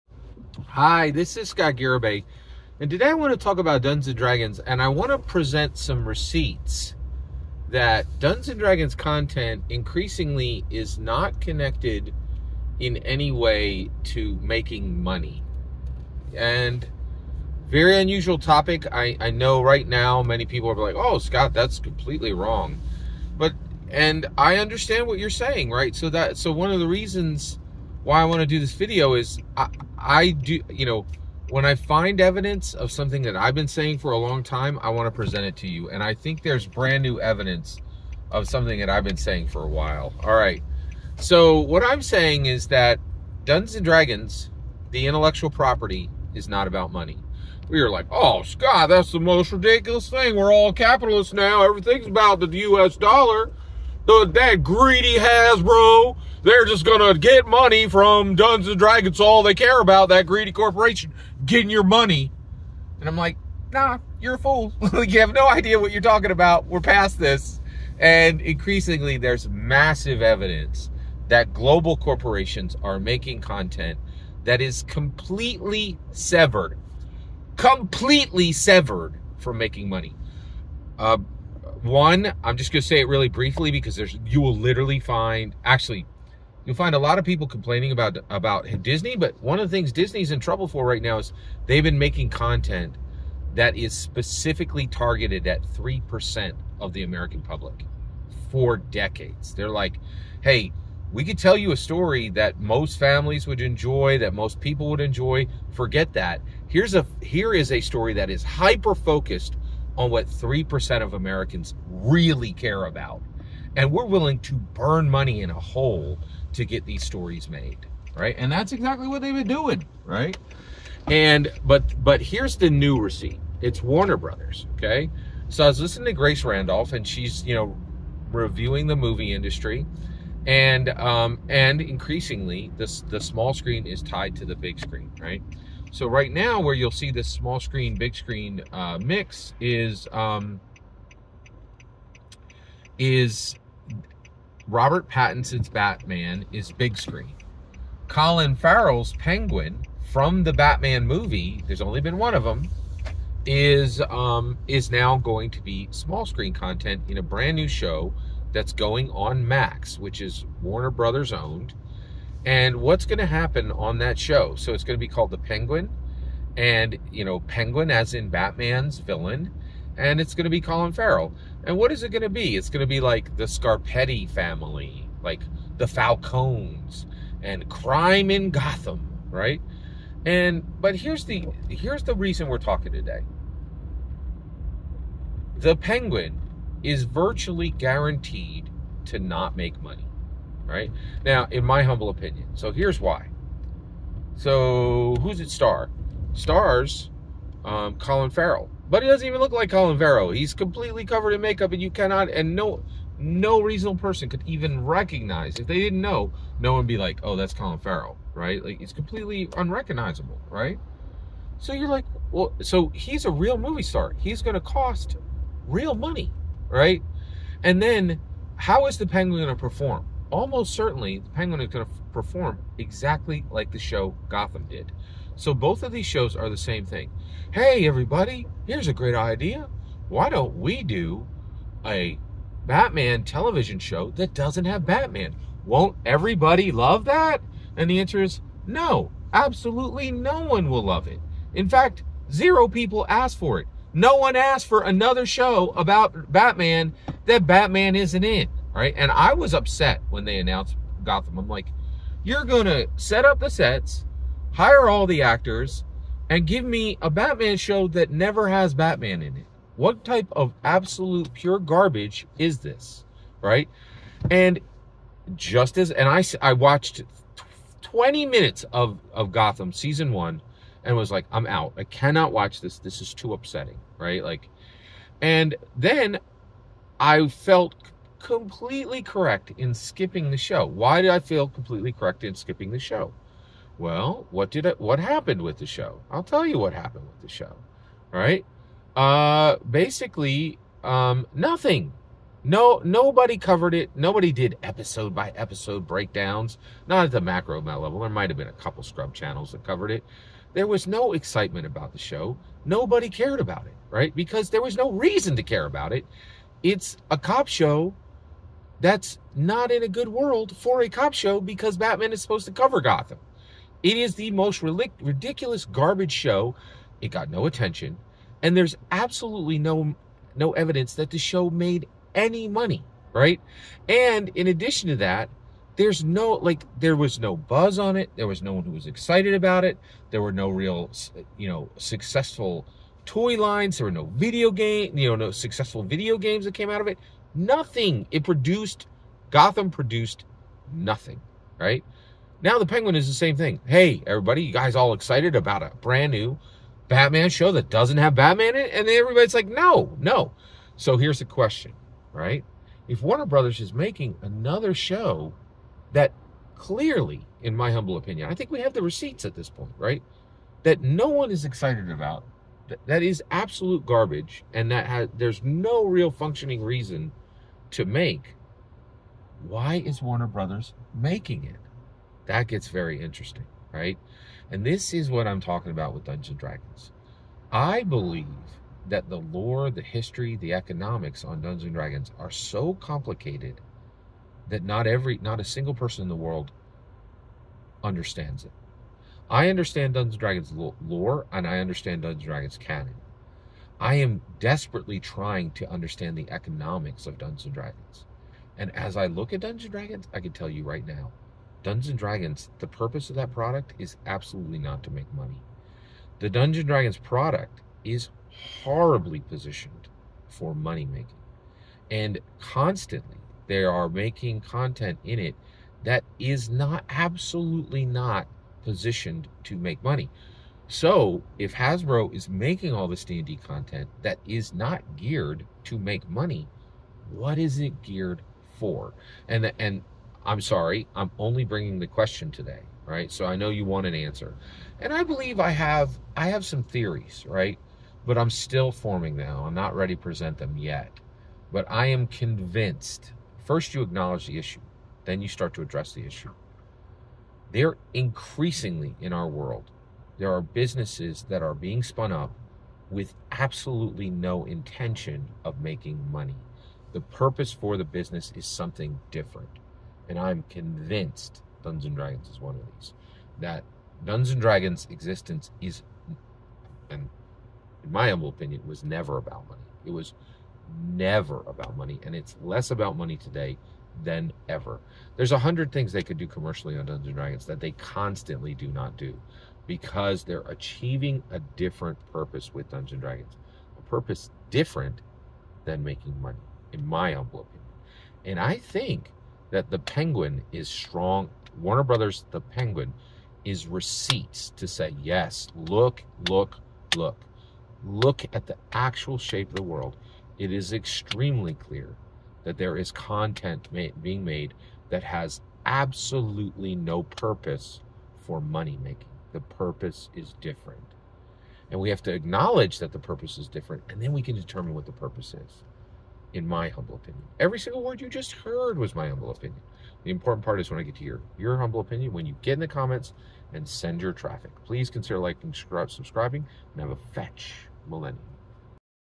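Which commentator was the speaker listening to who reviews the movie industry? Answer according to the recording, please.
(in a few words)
Grace Randolph.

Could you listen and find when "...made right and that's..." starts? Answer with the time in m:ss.
1:57.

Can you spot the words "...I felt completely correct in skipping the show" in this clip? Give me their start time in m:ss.
4:36.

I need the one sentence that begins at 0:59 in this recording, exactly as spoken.
All they care about that greedy corporation getting your money.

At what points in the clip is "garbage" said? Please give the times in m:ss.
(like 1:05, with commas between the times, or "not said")
4:21, 5:15, 6:03.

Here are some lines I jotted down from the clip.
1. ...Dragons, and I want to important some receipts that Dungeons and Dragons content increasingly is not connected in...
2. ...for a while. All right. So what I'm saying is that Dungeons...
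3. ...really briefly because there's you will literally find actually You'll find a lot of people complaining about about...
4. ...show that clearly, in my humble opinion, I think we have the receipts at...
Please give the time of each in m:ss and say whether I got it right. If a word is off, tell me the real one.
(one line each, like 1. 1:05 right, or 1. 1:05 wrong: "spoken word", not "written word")
1. 0:04 wrong: "present", not "important"
2. 0:39 right
3. 1:23 right
4. 5:54 right.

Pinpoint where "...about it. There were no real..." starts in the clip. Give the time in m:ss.
5:29.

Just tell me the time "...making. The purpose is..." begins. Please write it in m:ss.
8:28.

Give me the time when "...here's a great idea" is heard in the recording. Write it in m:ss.
3:48.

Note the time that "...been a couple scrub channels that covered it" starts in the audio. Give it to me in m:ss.
4:58.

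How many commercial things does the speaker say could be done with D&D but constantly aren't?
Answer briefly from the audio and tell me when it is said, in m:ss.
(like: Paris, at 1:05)
100, at 7:55.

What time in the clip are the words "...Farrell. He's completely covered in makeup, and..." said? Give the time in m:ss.
3:19.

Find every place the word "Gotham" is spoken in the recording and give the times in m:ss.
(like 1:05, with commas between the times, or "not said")
2:58, 3:44, 4:11, 4:29, 5:12, 5:39.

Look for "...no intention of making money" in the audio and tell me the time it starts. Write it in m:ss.
7:34.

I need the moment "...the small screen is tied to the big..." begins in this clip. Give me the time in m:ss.
2:13.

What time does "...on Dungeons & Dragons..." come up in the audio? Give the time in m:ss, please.
6:21.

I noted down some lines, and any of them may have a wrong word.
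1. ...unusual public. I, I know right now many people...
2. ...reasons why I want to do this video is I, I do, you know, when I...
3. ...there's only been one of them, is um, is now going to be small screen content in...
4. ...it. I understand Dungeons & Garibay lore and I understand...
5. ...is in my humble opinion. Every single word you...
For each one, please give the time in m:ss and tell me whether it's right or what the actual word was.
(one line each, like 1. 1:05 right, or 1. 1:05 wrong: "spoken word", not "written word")
1. 0:17 wrong: "topic", not "public"
2. 0:26 right
3. 2:31 right
4. 6:28 wrong: "Dragons", not "Garibay"
5. 8:35 right.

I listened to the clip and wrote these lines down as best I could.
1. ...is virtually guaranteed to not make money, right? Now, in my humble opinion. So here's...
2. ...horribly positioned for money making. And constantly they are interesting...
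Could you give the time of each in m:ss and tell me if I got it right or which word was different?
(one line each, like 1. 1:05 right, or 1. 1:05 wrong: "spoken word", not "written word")
1. 3:06 right
2. 6:48 wrong: "making", not "interesting".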